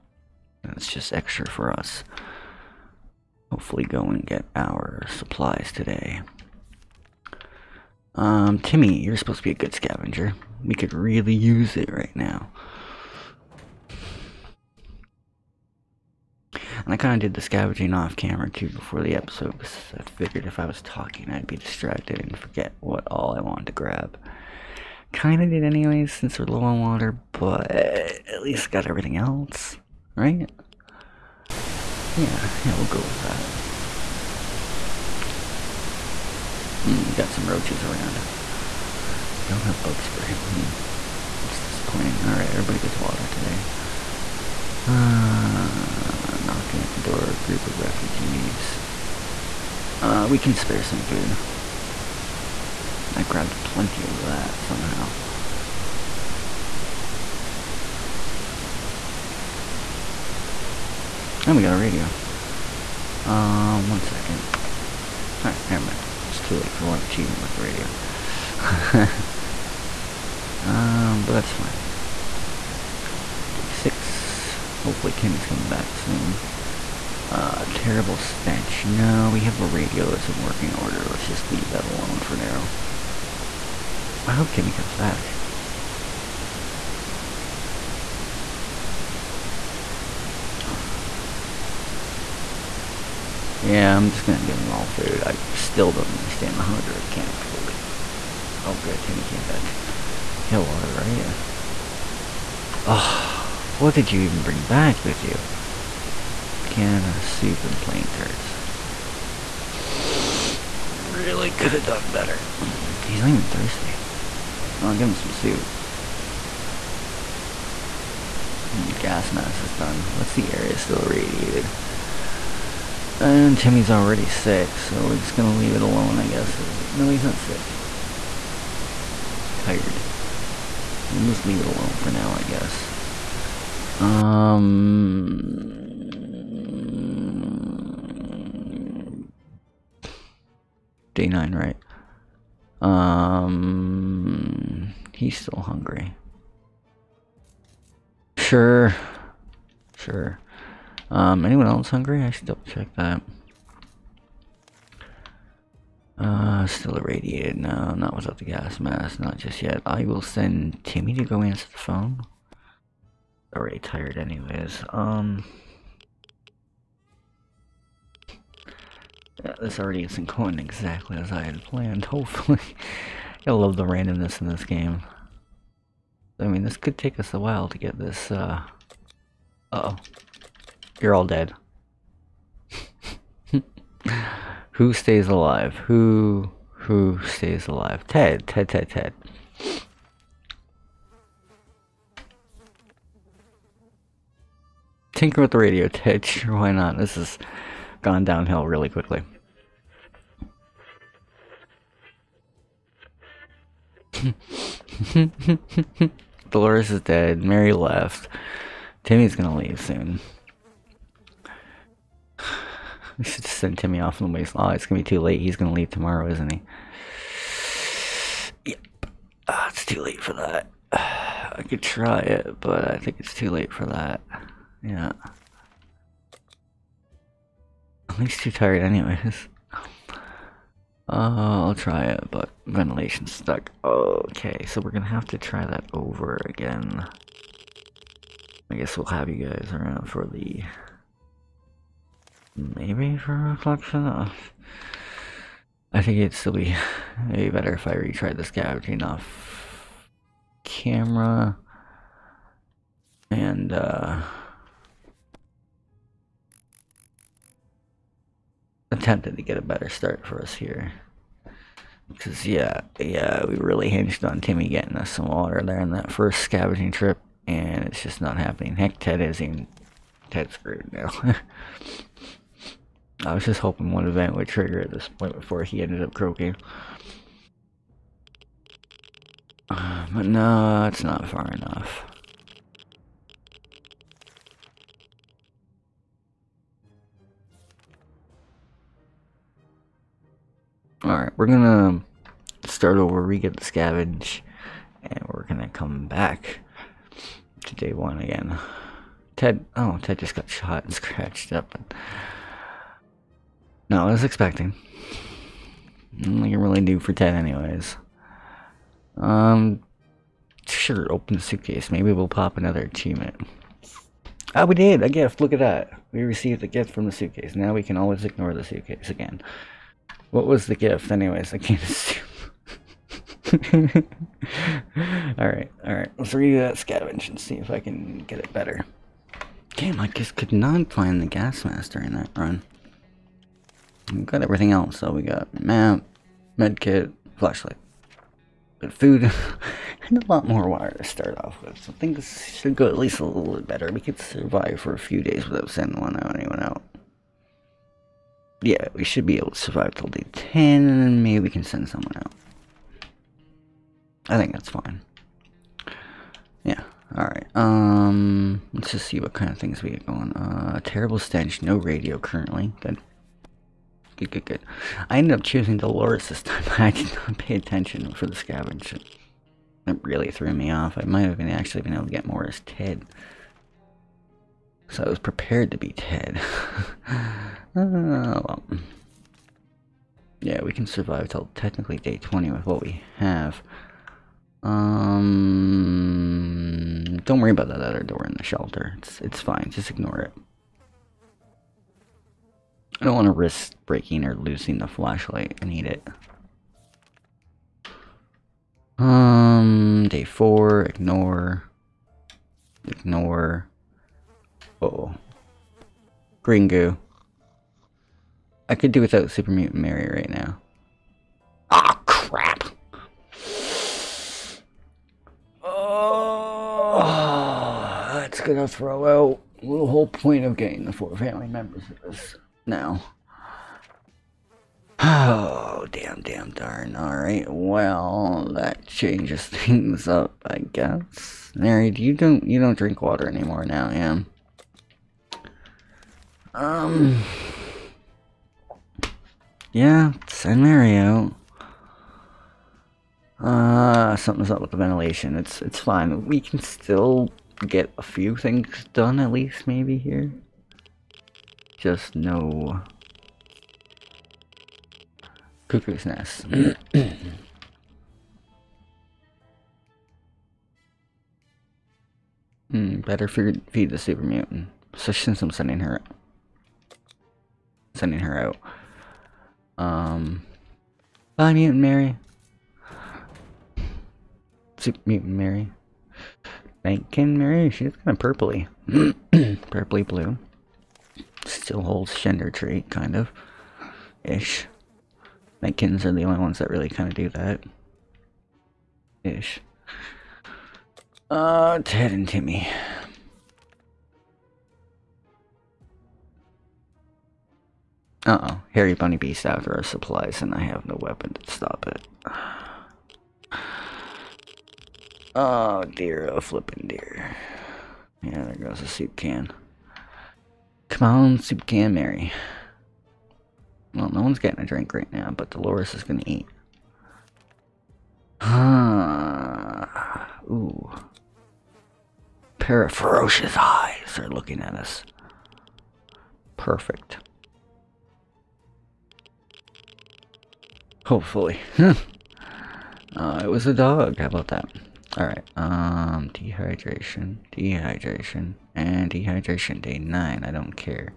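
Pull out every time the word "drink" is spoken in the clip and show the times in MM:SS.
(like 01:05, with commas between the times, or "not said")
07:12, 08:34.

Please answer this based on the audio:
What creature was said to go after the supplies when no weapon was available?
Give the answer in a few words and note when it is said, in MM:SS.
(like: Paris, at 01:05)
Harry Bunny Beast, at 08:18.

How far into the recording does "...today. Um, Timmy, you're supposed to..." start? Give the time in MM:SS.
00:05.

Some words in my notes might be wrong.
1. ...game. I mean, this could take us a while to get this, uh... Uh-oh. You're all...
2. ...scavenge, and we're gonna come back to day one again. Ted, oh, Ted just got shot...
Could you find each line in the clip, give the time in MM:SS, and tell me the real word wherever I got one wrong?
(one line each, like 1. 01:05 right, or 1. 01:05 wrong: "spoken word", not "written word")
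1. 02:54 right
2. 04:53 right.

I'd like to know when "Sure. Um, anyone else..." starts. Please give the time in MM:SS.
02:29.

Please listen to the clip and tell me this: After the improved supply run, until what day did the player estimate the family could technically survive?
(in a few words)
Day 20.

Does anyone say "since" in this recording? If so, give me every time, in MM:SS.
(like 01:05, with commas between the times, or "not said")
00:26, 07:45.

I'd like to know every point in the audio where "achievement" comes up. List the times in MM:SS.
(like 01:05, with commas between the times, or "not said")
01:06, 05:12.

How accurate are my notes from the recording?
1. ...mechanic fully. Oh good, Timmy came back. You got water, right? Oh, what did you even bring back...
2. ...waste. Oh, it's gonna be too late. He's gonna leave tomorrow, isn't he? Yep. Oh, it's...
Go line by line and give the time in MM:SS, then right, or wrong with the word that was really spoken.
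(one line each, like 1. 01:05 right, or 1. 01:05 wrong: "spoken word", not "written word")
1. 01:36 right
2. 03:34 right.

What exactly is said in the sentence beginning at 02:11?
we'll just leave it alone for now, I guess.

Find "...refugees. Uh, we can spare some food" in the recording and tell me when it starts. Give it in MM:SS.
00:47.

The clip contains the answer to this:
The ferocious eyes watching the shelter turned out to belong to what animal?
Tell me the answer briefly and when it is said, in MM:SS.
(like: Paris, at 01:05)
A dog, at 08:53.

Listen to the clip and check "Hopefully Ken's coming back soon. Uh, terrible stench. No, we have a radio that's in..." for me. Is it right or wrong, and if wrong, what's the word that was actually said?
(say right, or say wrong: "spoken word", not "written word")
wrong: "Timmy", not "Ken".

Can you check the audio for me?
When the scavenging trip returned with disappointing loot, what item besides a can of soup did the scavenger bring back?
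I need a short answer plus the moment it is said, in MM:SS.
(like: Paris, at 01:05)
Playing cards, at 01:47.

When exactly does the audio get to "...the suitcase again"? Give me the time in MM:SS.
05:18.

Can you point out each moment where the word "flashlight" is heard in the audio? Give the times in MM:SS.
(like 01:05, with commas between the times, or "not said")
05:37, 06:34.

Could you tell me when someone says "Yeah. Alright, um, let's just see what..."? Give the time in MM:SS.
05:56.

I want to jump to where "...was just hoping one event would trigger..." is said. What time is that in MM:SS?
04:33.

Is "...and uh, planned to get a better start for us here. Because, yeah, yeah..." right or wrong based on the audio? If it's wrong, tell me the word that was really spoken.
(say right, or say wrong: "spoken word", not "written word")
wrong: "attempted", not "planned".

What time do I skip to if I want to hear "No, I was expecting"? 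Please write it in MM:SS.
05:03.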